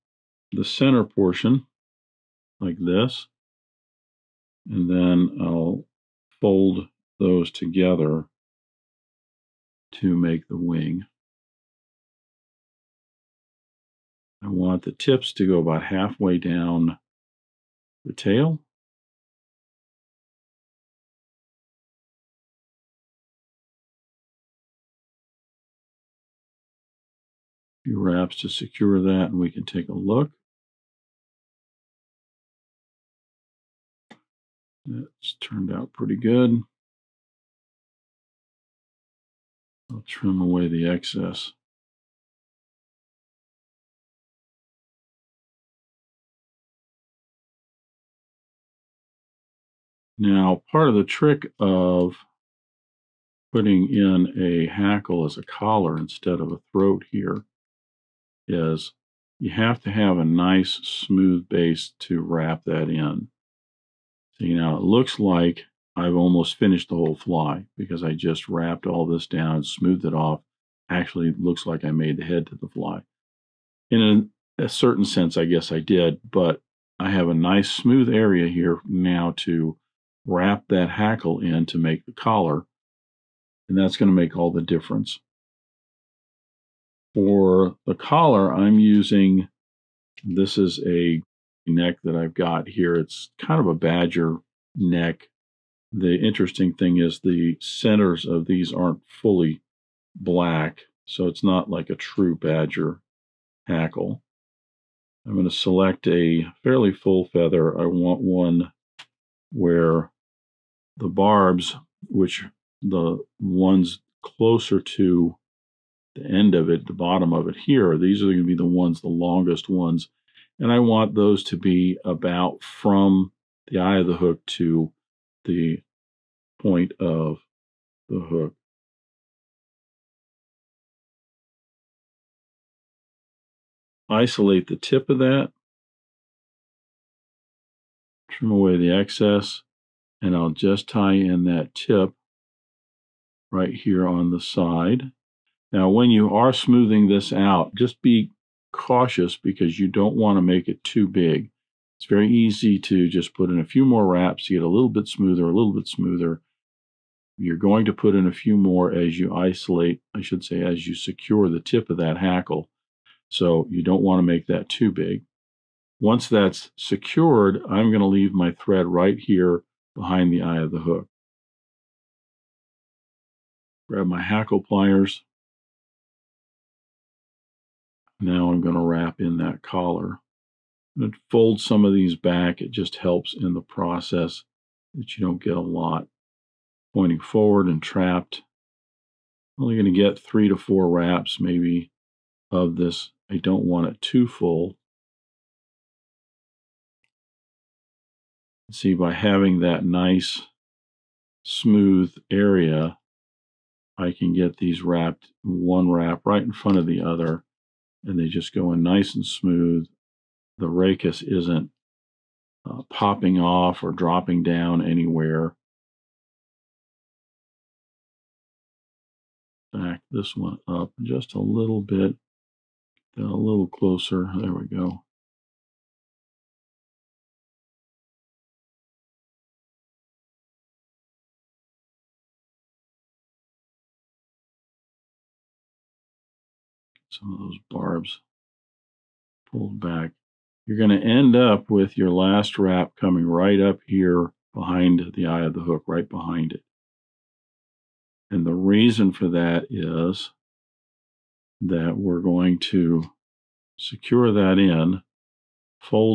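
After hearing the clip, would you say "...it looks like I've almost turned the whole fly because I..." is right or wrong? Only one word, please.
wrong.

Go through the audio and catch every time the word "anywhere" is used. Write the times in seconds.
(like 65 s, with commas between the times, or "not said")
214 s.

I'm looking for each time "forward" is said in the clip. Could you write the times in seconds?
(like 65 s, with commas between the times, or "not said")
187 s.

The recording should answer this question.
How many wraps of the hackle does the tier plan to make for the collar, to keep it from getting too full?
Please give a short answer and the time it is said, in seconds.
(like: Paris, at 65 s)
3 to 4, at 190 s.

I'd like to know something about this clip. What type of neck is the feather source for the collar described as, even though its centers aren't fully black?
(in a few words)
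Badger neck.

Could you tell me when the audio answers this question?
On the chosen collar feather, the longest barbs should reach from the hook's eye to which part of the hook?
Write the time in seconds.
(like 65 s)
126 s.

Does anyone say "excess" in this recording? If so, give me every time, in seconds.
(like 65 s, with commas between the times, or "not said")
40 s, 138 s.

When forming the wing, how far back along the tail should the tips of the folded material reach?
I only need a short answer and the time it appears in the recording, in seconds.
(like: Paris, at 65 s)
About halfway, at 15 s.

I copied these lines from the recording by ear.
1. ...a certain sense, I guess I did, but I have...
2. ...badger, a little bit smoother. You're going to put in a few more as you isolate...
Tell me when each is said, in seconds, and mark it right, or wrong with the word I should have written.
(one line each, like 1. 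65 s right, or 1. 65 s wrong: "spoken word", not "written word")
1. 74 s right
2. 155 s wrong: "smoother", not "badger".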